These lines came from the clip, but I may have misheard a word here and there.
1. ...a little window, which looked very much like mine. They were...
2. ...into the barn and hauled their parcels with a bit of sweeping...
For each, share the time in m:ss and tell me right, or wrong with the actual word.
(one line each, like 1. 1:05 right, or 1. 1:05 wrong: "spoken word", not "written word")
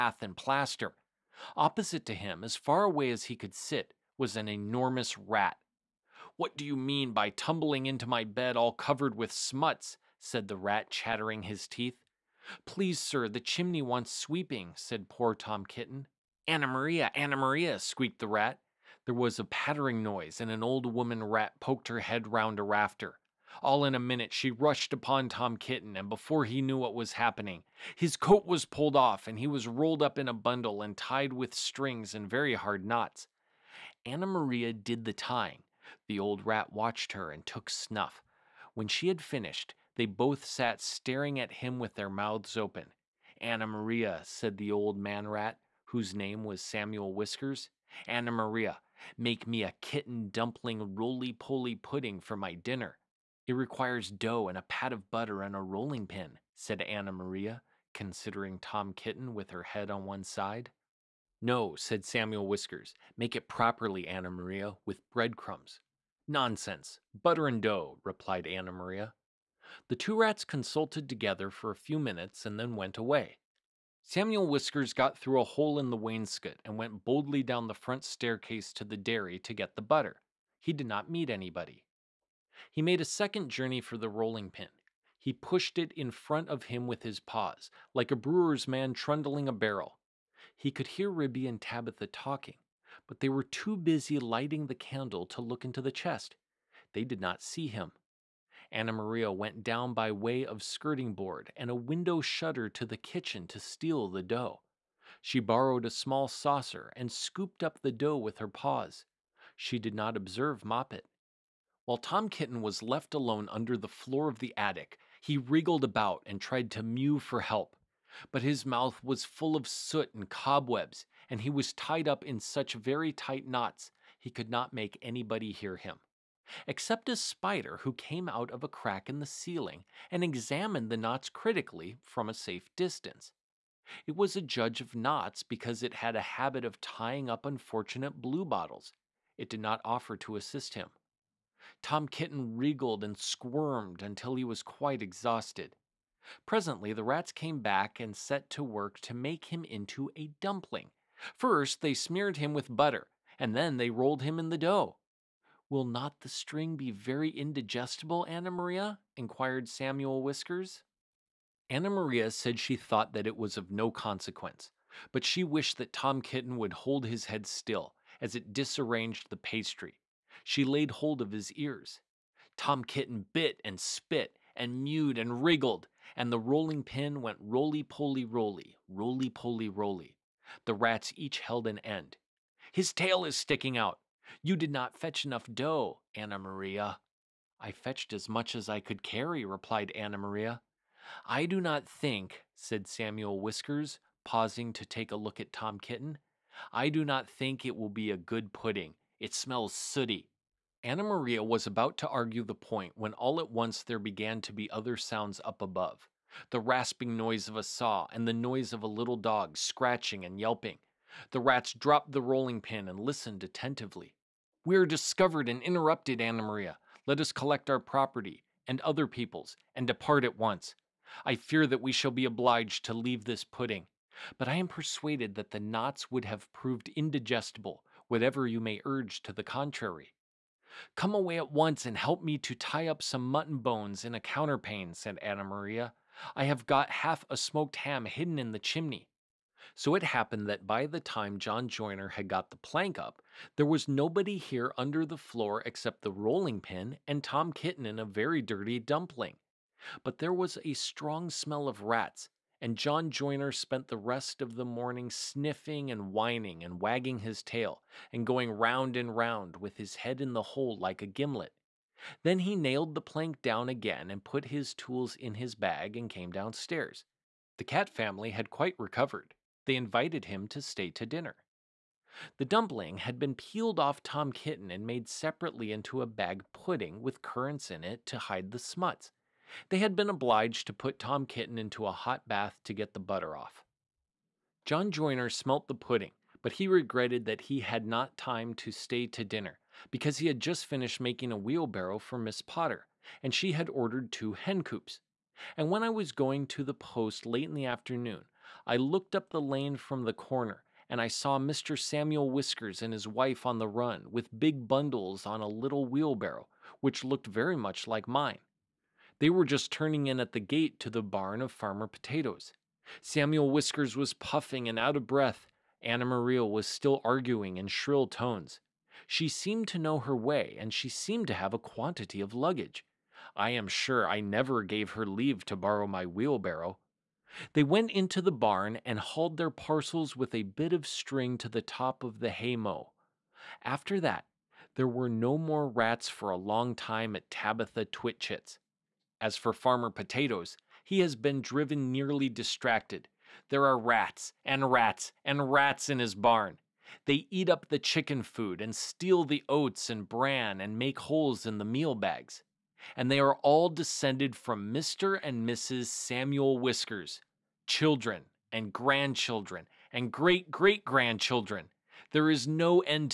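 1. 5:05 wrong: "wheelbarrow", not "window"
2. 5:27 wrong: "string", not "sweeping".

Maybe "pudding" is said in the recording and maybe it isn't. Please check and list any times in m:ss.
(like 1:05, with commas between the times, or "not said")
0:51, 3:18, 3:43, 4:36, 4:45.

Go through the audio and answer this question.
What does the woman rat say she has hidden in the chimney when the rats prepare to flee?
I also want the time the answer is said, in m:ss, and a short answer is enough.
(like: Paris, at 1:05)
Half a smoked ham, at 3:57.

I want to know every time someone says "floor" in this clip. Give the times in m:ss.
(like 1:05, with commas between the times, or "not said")
1:53, 4:05.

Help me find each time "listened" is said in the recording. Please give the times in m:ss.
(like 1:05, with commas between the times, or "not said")
3:32.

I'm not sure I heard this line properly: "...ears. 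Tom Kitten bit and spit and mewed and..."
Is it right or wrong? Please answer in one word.
right.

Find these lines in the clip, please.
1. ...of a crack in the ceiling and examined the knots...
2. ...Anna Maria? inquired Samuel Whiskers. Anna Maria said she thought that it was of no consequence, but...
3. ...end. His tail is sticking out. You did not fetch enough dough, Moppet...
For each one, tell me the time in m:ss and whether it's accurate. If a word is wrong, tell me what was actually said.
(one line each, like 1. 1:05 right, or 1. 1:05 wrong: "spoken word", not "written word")
1. 2:08 right
2. 2:38 right
3. 3:01 wrong: "Anna", not "Moppet".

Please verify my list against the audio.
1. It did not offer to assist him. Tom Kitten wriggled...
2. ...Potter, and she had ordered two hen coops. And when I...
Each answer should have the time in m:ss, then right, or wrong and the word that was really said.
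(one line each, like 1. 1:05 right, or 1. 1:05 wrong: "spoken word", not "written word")
1. 2:19 right
2. 4:52 right.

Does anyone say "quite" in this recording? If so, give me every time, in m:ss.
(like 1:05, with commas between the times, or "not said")
2:24, 4:28.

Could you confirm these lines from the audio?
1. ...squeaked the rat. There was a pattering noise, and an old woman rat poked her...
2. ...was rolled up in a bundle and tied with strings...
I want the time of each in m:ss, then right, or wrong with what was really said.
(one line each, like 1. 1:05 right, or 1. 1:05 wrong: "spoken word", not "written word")
1. 0:17 right
2. 0:29 right.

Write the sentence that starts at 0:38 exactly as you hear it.
When she had finished, they both sat staring at him with their mouths open.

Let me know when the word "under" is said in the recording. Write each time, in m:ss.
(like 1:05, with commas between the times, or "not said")
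1:53, 4:04.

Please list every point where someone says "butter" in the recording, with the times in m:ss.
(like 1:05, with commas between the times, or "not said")
0:55, 1:07, 1:19, 2:32, 4:42.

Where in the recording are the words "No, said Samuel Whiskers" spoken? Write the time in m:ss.
1:01.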